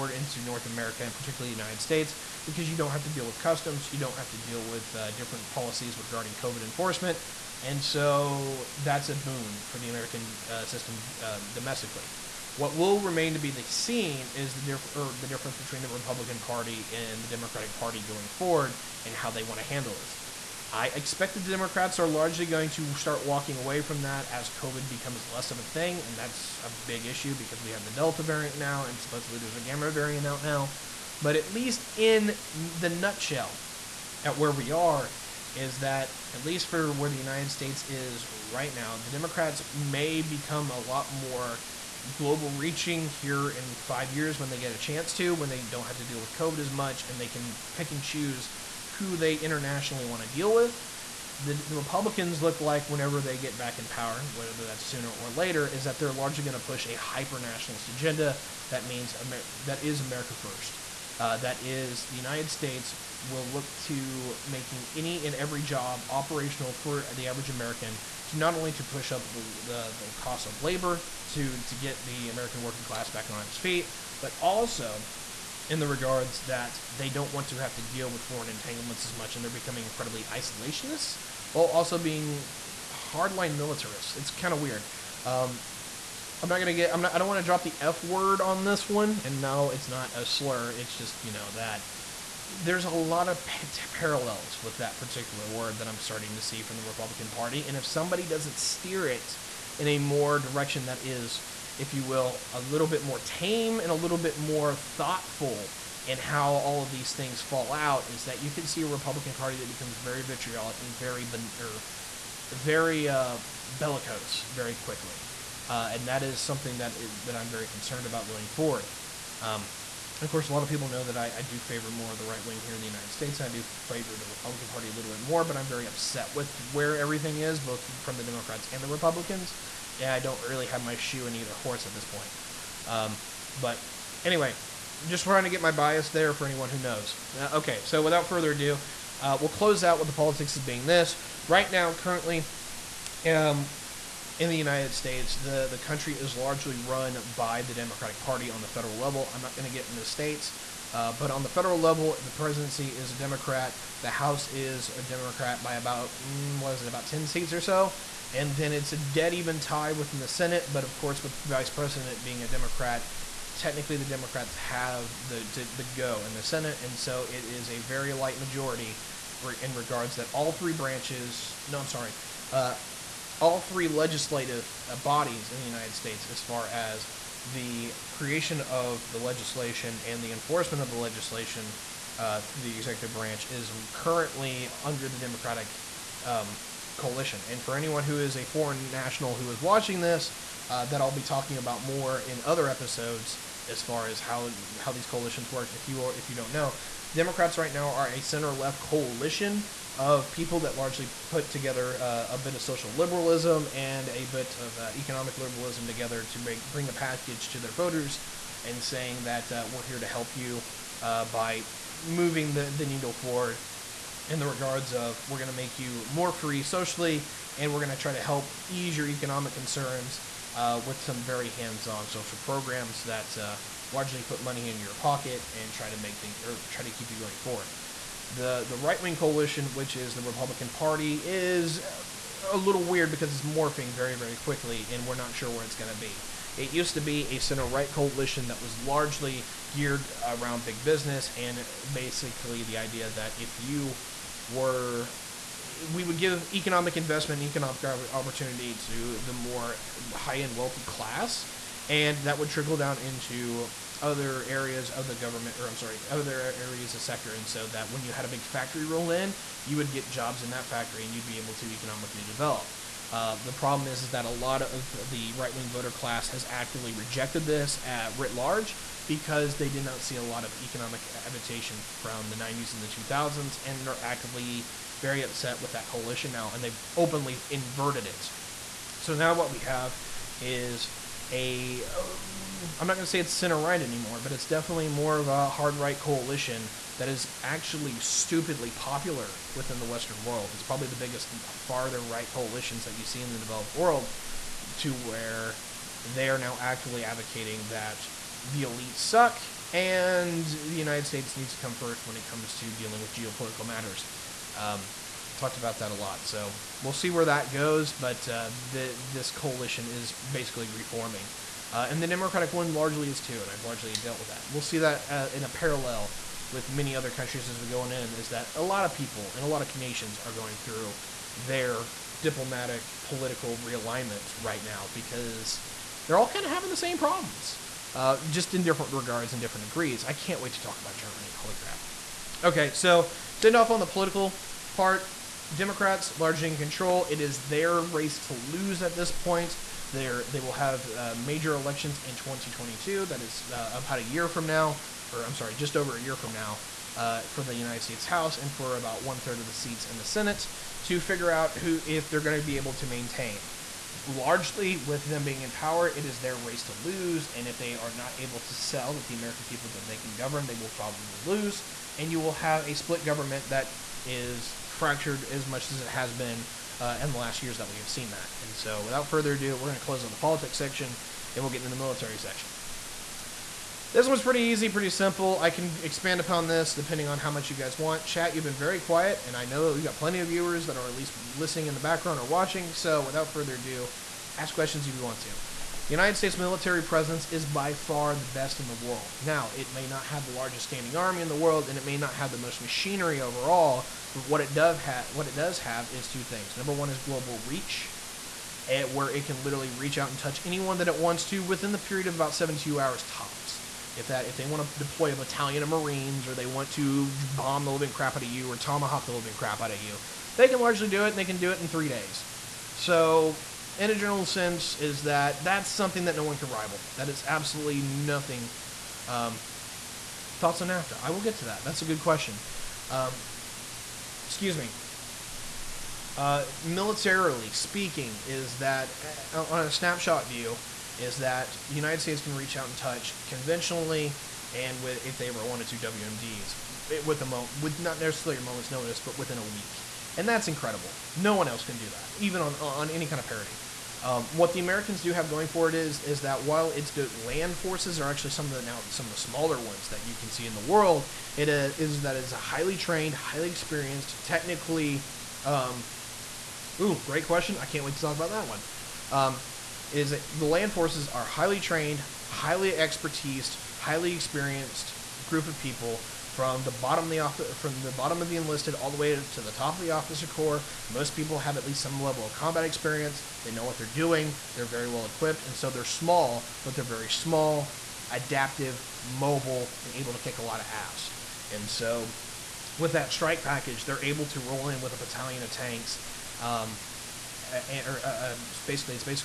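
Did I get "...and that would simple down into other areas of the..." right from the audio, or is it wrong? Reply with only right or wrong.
wrong.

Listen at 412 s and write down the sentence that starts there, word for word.
So in a general sense is that that's something that no one can rival.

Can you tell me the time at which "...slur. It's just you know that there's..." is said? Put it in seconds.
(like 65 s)
90 s.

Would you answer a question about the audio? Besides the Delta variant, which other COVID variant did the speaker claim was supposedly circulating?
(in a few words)
Gamma.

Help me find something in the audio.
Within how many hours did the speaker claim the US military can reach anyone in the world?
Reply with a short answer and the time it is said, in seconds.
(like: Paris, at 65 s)
72, at 402 s.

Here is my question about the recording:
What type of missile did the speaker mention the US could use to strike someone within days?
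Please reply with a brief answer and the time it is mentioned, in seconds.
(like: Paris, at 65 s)
tomahawk, at 408 s.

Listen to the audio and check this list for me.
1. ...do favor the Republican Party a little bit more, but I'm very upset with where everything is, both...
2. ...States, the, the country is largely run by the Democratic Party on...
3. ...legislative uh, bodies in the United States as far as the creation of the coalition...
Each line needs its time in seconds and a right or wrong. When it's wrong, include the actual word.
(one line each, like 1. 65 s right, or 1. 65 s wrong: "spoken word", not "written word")
1. 123 s right
2. 144 s right
3. 173 s wrong: "legislation", not "coalition".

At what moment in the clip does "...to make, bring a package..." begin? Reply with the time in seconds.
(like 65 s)
206 s.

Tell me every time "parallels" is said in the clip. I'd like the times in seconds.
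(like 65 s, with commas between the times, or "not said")
93 s, 315 s.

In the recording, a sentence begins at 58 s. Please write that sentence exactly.
That means Amer- that is America first.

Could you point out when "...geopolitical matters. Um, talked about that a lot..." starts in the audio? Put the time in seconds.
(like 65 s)
303 s.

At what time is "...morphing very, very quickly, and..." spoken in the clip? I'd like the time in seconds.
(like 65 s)
233 s.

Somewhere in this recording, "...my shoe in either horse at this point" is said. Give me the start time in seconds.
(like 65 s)
130 s.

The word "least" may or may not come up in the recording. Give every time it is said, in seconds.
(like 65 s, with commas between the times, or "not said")
31 s, 36 s, 380 s, 471 s.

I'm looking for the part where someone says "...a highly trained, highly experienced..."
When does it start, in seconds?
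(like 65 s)
452 s.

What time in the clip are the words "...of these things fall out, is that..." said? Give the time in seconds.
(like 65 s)
106 s.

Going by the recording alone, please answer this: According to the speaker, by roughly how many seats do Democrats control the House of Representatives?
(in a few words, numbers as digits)
10.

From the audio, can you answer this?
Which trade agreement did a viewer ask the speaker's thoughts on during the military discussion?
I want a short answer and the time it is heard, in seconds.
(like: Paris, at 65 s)
NAFTA, at 420 s.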